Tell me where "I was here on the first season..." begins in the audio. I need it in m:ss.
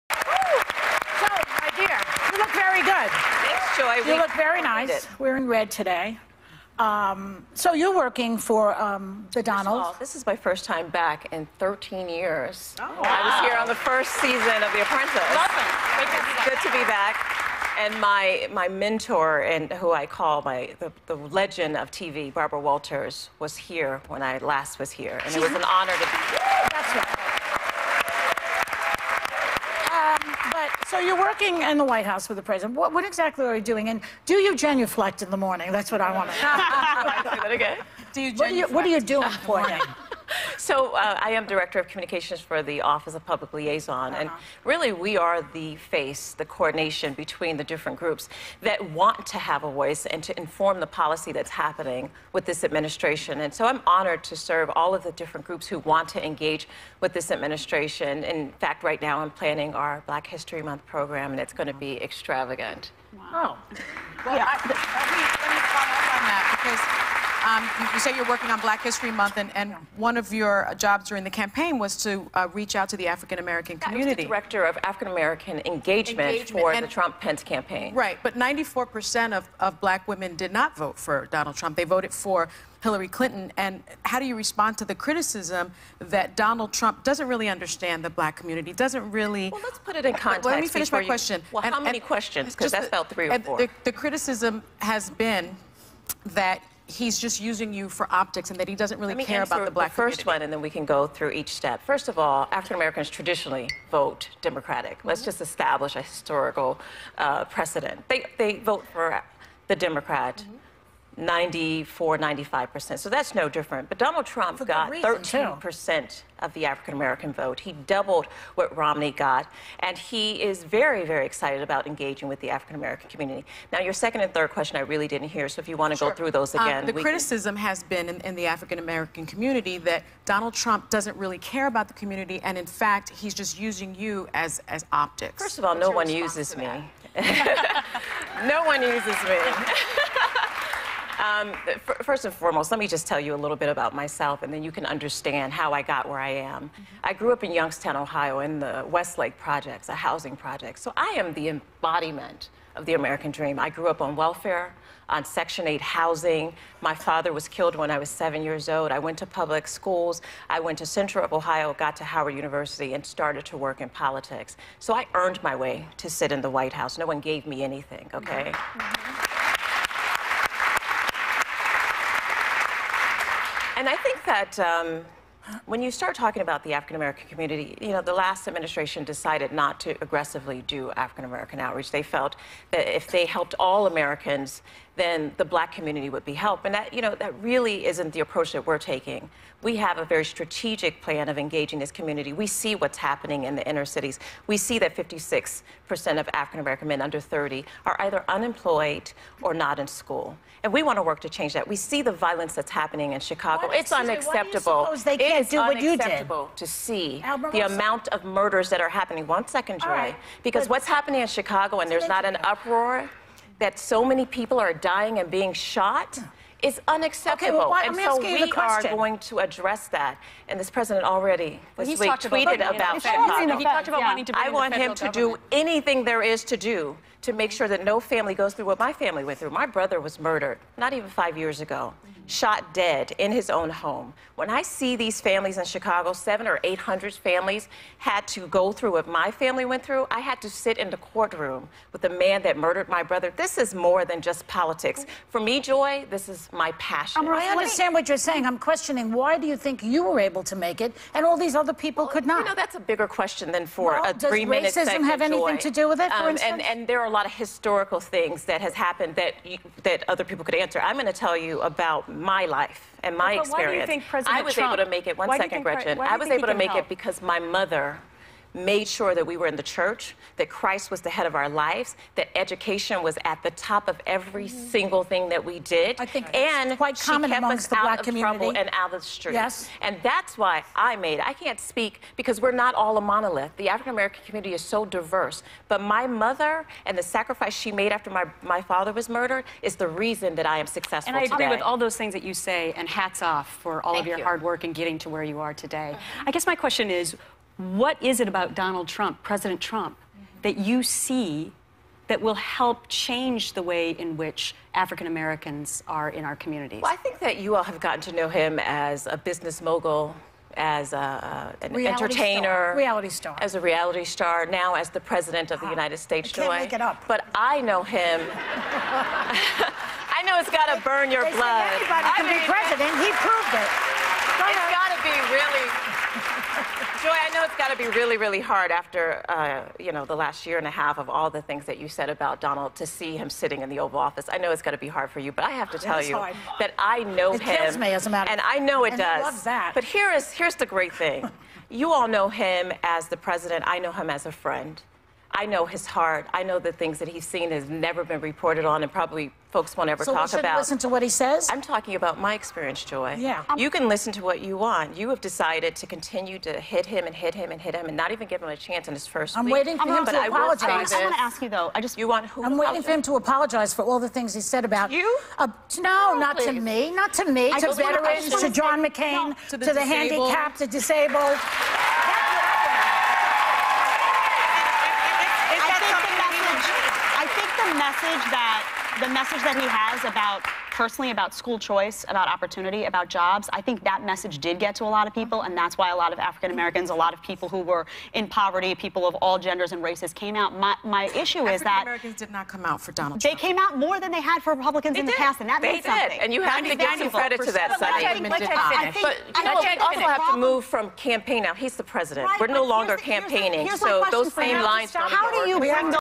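0:13.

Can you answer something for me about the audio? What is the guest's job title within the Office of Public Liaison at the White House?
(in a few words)
Director of Communications.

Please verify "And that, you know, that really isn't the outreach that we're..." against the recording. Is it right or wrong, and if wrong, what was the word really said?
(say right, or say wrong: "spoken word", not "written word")
wrong: "approach", not "outreach".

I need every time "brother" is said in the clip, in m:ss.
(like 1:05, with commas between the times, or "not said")
3:49, 4:03.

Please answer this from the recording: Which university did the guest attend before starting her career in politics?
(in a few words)
Howard University.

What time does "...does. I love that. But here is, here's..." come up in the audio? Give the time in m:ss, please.
5:38.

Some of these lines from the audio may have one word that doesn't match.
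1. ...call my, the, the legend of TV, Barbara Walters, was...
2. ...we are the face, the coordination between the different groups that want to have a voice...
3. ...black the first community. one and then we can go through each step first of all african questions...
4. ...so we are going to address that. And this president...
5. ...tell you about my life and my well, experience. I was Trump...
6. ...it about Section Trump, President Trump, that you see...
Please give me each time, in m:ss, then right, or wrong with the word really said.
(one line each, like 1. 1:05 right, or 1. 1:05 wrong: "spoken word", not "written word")
1. 0:20 right
2. 0:45 right
3. 1:39 wrong: "americans", not "questions"
4. 3:37 right
5. 4:21 right
6. 4:58 wrong: "Donald", not "Section".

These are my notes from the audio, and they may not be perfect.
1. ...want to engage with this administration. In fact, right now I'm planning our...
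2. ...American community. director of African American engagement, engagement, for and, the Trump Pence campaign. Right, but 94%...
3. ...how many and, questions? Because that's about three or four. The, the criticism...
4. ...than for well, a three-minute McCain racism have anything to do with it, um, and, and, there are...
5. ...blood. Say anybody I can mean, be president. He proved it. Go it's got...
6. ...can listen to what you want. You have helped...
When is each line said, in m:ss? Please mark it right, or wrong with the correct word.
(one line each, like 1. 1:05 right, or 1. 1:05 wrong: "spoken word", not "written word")
1. 0:55 right
2. 1:13 right
3. 1:31 right
4. 4:13 wrong: "Does", not "McCain"
5. 5:21 right
6. 5:53 wrong: "decided", not "helped".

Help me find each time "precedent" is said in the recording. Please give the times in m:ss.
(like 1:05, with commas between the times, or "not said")
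1:47.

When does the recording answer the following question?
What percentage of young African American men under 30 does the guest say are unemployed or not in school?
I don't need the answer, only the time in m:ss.
3:14.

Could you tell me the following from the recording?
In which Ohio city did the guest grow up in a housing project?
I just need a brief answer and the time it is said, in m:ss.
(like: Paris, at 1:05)
Youngstown, at 2:27.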